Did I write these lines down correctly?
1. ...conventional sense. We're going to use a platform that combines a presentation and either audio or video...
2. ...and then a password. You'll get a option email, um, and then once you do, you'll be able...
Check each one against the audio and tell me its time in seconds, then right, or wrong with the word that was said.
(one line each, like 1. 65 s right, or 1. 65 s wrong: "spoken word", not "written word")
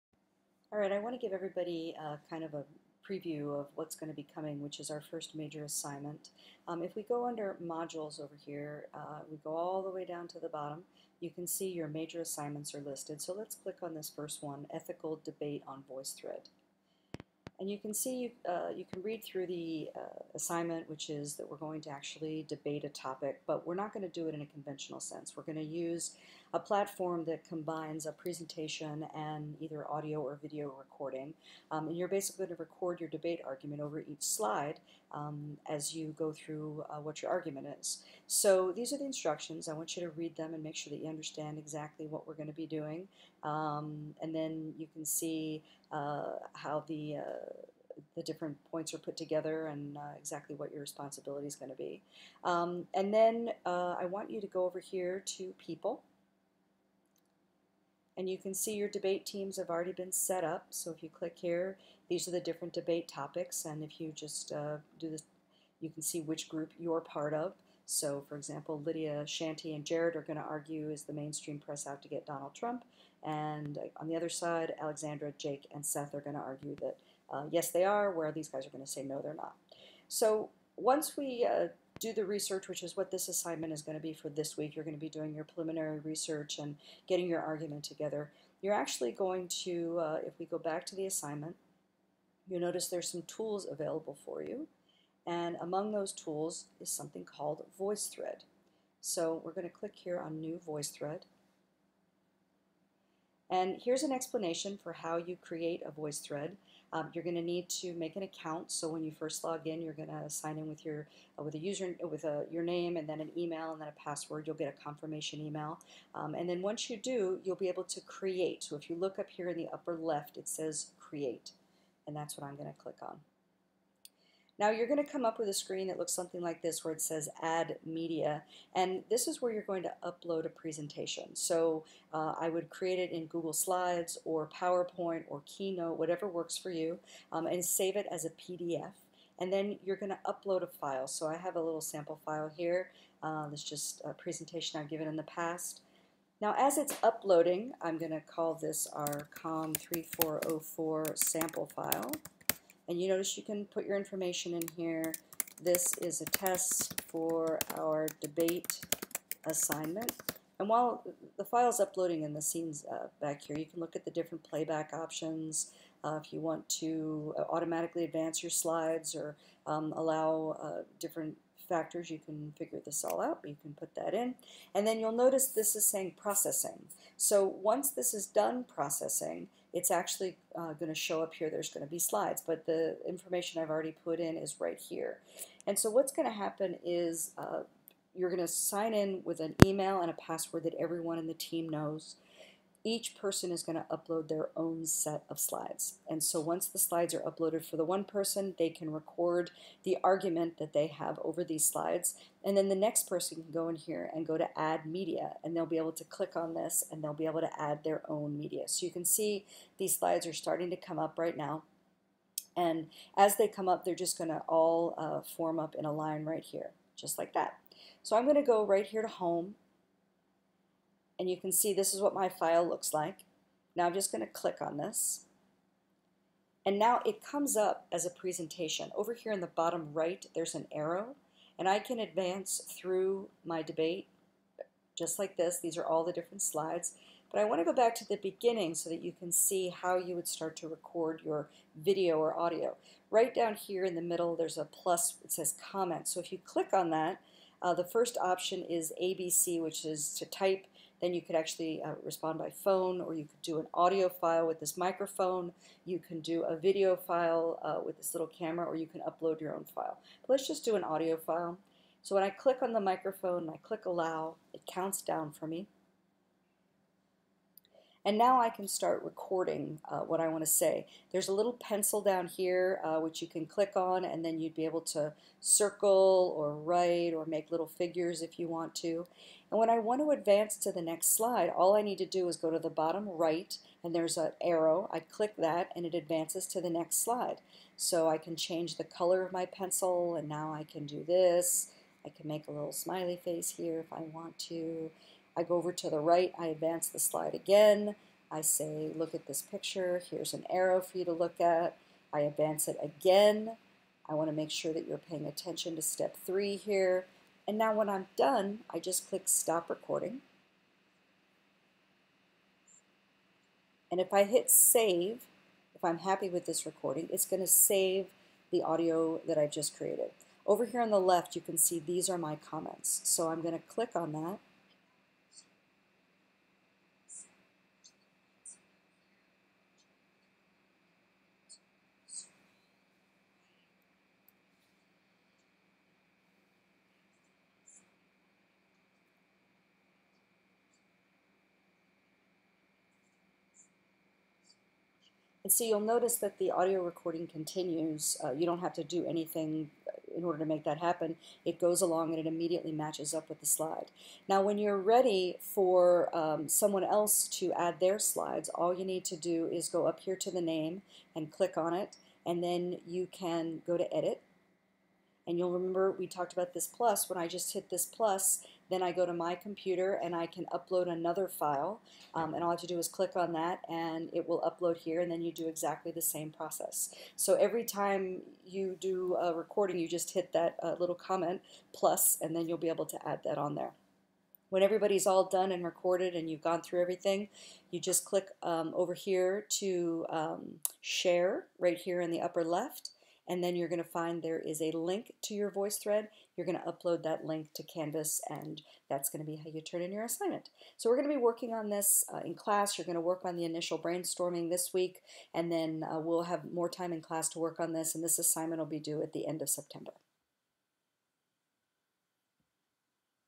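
1. 24 s right
2. 113 s wrong: "confirmation", not "option".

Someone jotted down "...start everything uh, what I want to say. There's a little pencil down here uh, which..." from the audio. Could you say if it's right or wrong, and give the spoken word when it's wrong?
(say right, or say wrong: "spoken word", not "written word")
wrong: "recording", not "everything".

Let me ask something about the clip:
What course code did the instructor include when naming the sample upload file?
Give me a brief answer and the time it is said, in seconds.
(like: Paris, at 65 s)
COM3404, at 149 s.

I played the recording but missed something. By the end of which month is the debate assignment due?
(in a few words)
September.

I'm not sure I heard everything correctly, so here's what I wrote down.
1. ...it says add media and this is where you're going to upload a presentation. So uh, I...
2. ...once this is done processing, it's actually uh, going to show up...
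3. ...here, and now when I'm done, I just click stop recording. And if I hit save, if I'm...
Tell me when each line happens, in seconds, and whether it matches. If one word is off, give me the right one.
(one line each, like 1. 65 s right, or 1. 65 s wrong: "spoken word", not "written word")
1. 126 s right
2. 177 s right
3. 306 s right.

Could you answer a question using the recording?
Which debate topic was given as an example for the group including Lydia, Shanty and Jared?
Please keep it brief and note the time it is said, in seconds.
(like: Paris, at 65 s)
Is the mainstream press out to get Donald Trump?, at 70 s.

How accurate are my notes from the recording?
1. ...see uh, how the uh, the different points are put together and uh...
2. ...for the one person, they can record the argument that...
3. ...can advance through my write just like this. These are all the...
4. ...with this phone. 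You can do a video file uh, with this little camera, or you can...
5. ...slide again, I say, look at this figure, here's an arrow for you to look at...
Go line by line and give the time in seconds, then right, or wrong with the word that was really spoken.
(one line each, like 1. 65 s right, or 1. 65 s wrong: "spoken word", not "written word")
1. 45 s right
2. 197 s right
3. 231 s wrong: "debate", not "write"
4. 254 s wrong: "microphone", not "phone"
5. 296 s wrong: "picture", not "figure".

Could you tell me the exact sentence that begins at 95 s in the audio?
And among those tools is something called VoiceThread.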